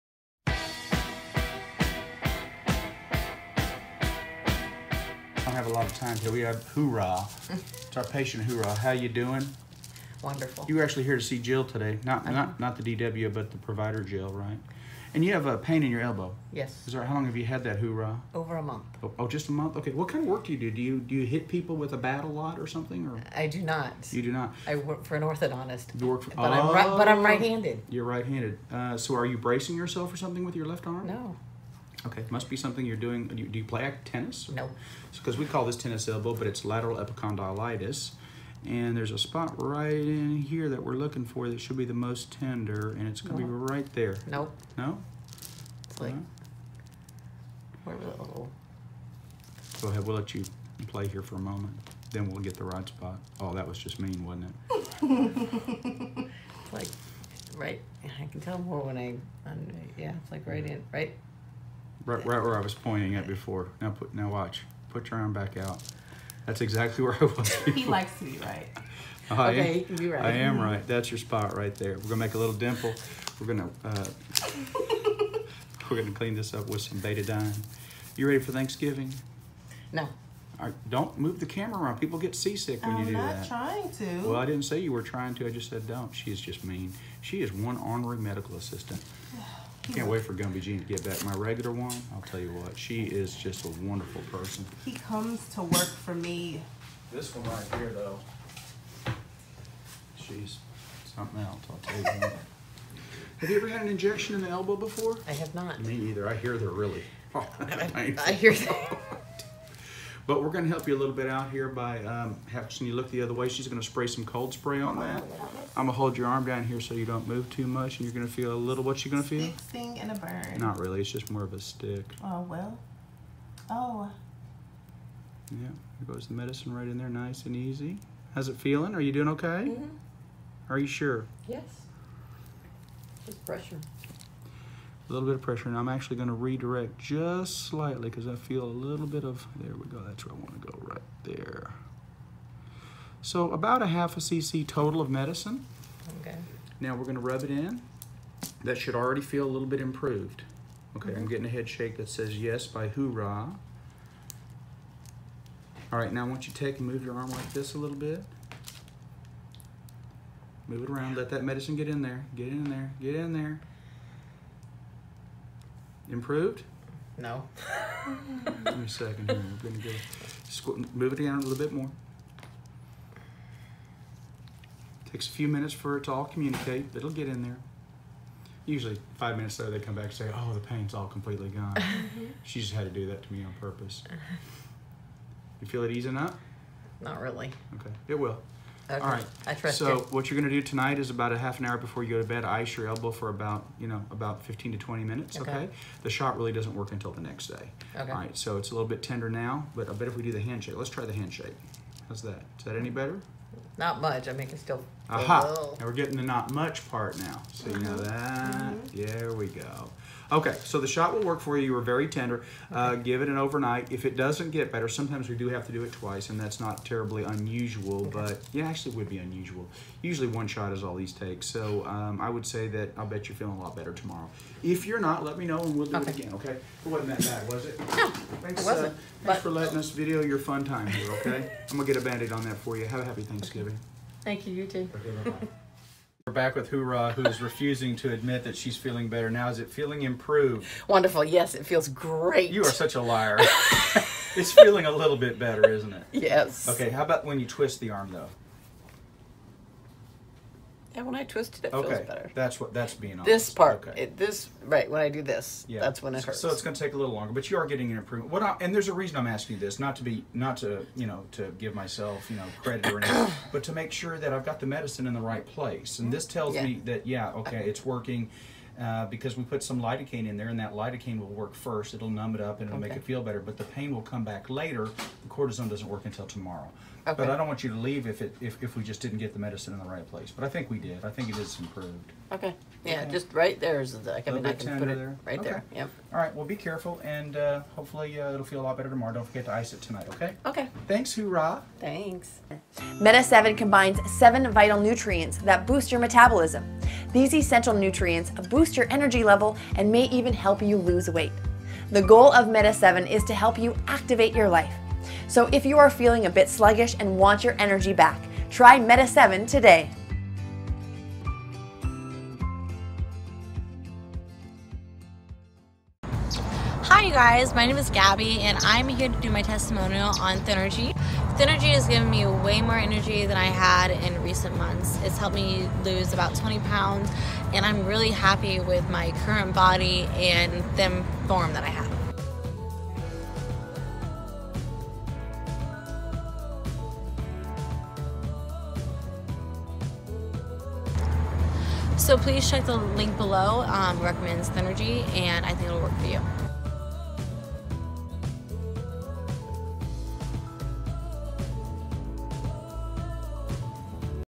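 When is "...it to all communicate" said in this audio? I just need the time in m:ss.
2:55.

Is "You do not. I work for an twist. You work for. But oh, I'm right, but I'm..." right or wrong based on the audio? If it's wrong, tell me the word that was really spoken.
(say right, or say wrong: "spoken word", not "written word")
wrong: "orthodontist", not "twist".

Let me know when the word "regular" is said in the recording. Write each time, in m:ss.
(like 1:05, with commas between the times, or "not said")
1:31.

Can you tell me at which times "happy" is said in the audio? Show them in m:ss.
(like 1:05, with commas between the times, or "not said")
3:53, 5:28.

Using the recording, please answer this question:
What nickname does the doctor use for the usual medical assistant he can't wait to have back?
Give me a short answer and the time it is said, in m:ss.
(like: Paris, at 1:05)
Gumby Jean, at 1:30.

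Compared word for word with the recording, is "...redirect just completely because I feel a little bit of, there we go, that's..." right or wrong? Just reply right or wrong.
wrong.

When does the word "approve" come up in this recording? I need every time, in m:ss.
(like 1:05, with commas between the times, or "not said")
not said.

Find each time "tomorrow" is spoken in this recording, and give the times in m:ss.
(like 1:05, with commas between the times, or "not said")
3:43, 4:36, 4:48.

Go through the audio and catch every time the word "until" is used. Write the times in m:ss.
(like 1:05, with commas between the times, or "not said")
3:16, 4:36.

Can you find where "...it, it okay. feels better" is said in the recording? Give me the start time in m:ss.
4:11.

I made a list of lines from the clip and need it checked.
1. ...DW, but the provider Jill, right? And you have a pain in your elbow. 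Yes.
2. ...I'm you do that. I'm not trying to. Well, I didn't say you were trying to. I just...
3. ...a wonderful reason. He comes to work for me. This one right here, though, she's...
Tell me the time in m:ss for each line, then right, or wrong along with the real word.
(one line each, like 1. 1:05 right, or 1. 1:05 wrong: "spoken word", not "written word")
1. 0:12 right
2. 1:22 right
3. 1:33 wrong: "person", not "reason".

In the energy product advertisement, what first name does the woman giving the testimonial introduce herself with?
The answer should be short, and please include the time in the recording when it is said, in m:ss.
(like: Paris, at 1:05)
Gabby, at 5:17.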